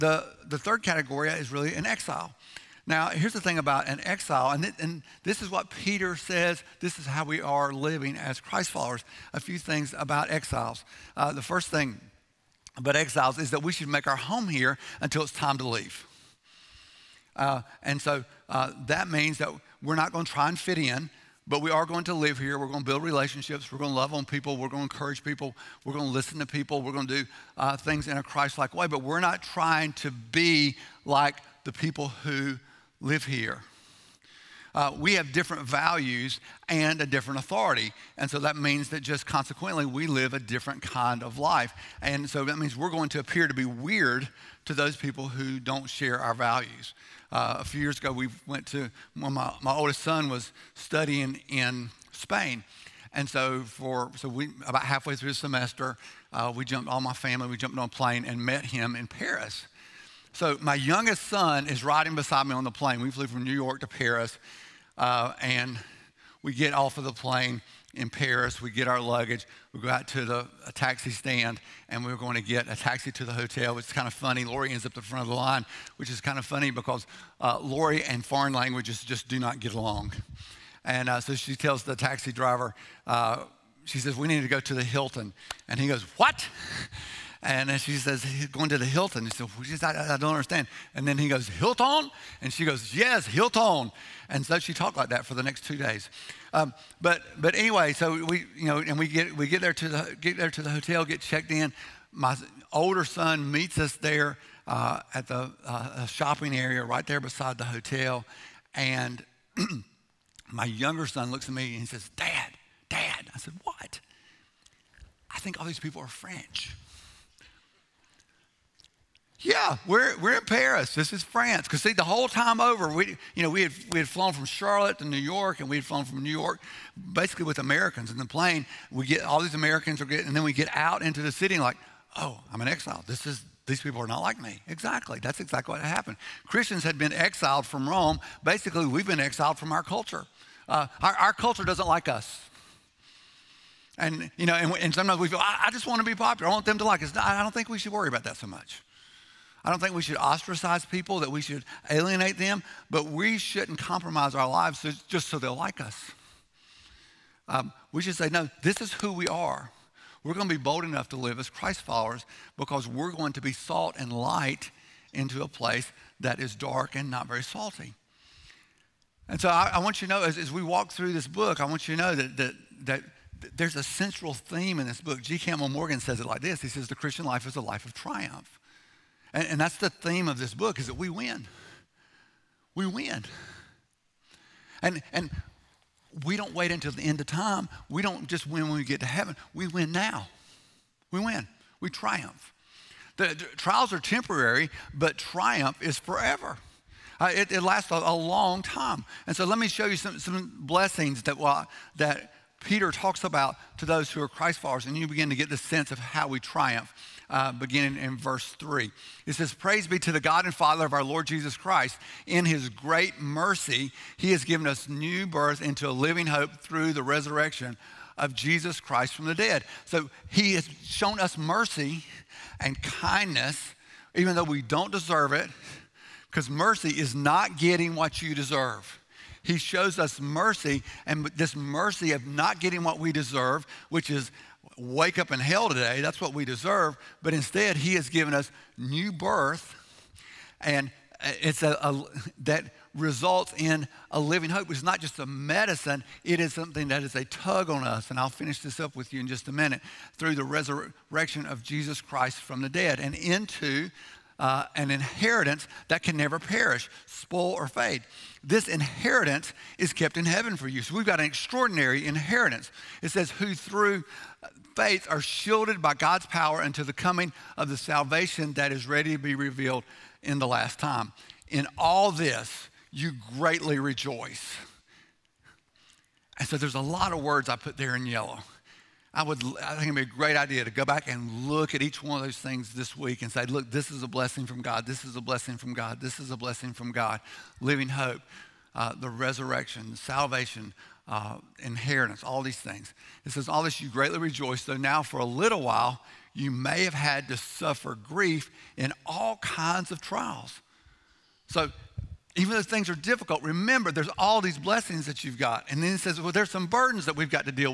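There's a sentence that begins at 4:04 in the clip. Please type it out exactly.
It's not just a medicine, it is something that is a tug on us.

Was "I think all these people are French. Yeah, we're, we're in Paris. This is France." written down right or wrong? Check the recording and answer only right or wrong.
right.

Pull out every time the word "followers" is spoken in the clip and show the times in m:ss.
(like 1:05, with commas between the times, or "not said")
0:08, 2:41, 3:24.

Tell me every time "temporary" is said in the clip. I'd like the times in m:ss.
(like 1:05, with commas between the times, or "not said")
3:13.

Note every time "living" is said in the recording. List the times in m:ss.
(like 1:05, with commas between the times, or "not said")
0:07, 3:35, 4:04, 4:47.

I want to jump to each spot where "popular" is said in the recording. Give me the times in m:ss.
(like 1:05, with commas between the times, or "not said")
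2:26.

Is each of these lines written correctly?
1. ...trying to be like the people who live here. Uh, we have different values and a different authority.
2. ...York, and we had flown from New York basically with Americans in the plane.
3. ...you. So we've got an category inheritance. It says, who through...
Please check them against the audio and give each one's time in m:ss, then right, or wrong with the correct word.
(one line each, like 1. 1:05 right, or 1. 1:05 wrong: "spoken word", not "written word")
1. 0:29 right
2. 2:05 right
3. 4:20 wrong: "extraordinary", not "category".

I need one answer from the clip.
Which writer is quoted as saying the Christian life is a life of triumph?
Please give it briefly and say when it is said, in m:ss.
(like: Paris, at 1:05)
G. Campbell Morgan, at 2:55.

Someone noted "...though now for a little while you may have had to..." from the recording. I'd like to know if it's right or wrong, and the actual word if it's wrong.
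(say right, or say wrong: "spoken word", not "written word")
right.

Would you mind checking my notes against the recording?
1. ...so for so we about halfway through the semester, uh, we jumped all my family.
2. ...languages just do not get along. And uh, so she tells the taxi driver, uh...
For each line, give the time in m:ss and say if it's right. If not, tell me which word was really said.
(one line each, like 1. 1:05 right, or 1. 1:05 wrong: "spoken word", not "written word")
1. 0:53 right
2. 1:18 right.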